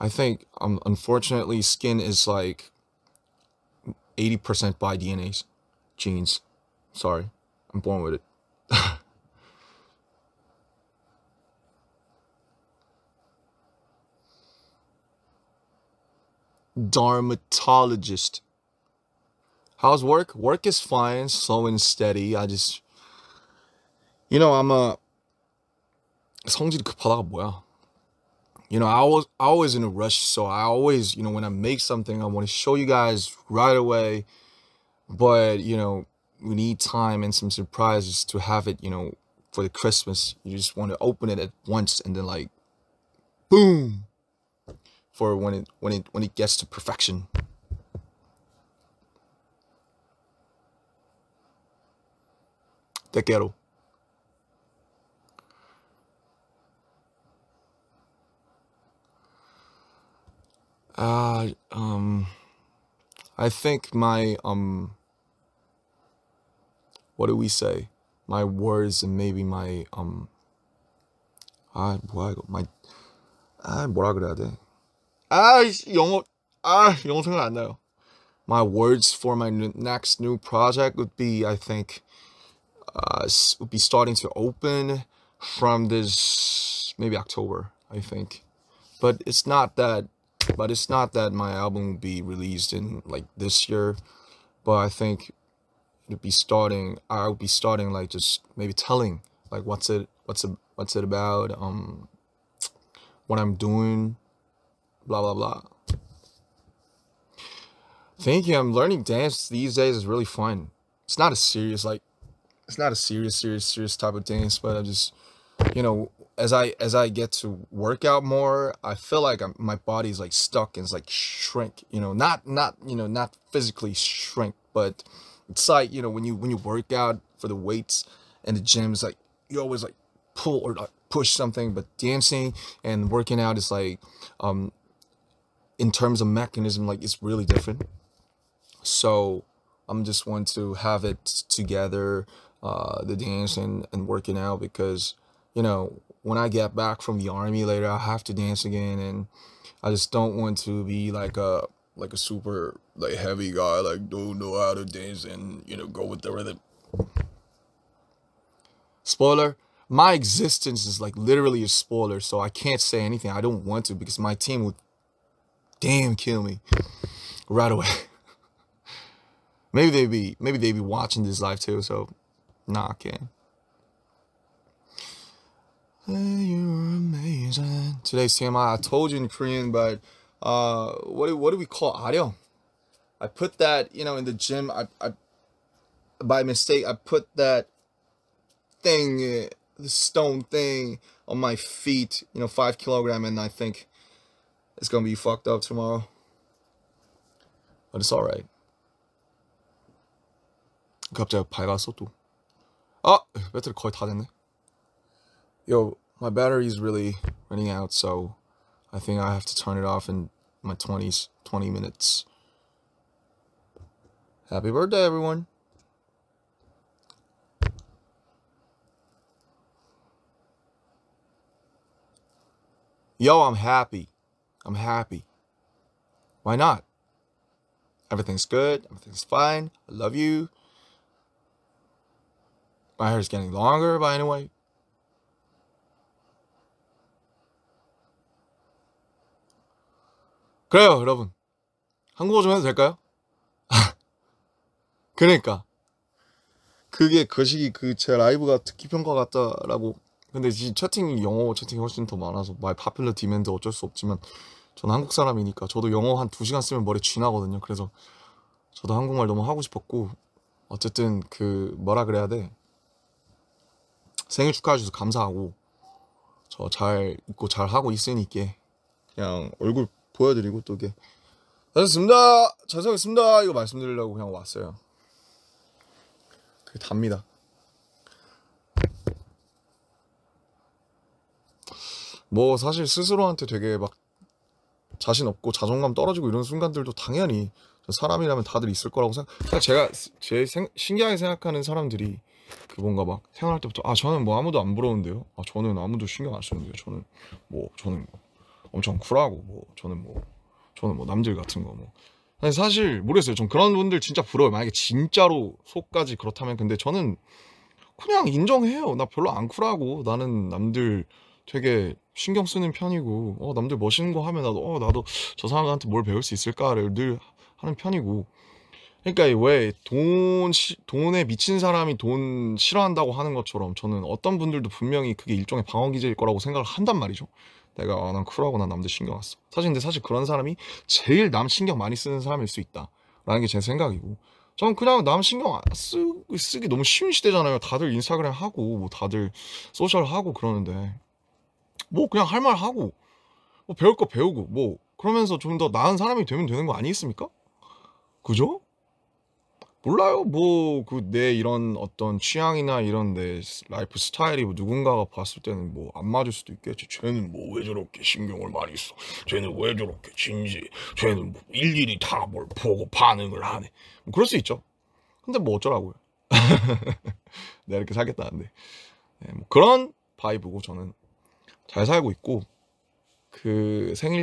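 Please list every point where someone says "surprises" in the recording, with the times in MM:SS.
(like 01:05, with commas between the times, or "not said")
00:37.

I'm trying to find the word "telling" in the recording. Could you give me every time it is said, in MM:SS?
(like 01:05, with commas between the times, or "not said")
01:38.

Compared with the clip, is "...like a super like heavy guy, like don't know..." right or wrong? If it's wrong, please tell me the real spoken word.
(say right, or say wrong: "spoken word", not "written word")
right.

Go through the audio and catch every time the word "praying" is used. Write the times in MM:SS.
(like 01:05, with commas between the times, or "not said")
not said.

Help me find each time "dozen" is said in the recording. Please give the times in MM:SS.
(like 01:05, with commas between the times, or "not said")
not said.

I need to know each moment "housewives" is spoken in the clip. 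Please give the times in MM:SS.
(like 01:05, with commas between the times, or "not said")
not said.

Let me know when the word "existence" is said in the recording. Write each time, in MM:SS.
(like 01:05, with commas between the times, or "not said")
02:40.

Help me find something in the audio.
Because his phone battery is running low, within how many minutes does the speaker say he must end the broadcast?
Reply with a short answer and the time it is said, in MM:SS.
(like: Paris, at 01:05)
20 minutes, at 03:31.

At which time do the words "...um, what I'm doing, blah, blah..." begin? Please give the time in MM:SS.
01:41.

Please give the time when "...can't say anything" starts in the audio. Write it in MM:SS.
02:42.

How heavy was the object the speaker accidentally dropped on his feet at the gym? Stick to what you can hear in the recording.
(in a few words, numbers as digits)
5 kilograms.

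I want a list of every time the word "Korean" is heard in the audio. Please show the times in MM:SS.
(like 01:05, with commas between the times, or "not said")
02:59.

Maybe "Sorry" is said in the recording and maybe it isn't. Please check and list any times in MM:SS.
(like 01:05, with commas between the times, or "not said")
00:06.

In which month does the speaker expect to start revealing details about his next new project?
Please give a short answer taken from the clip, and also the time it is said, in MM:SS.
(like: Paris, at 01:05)
October, at 01:27.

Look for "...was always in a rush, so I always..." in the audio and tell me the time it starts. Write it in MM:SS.
00:29.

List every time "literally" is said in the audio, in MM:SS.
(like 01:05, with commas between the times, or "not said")
02:41.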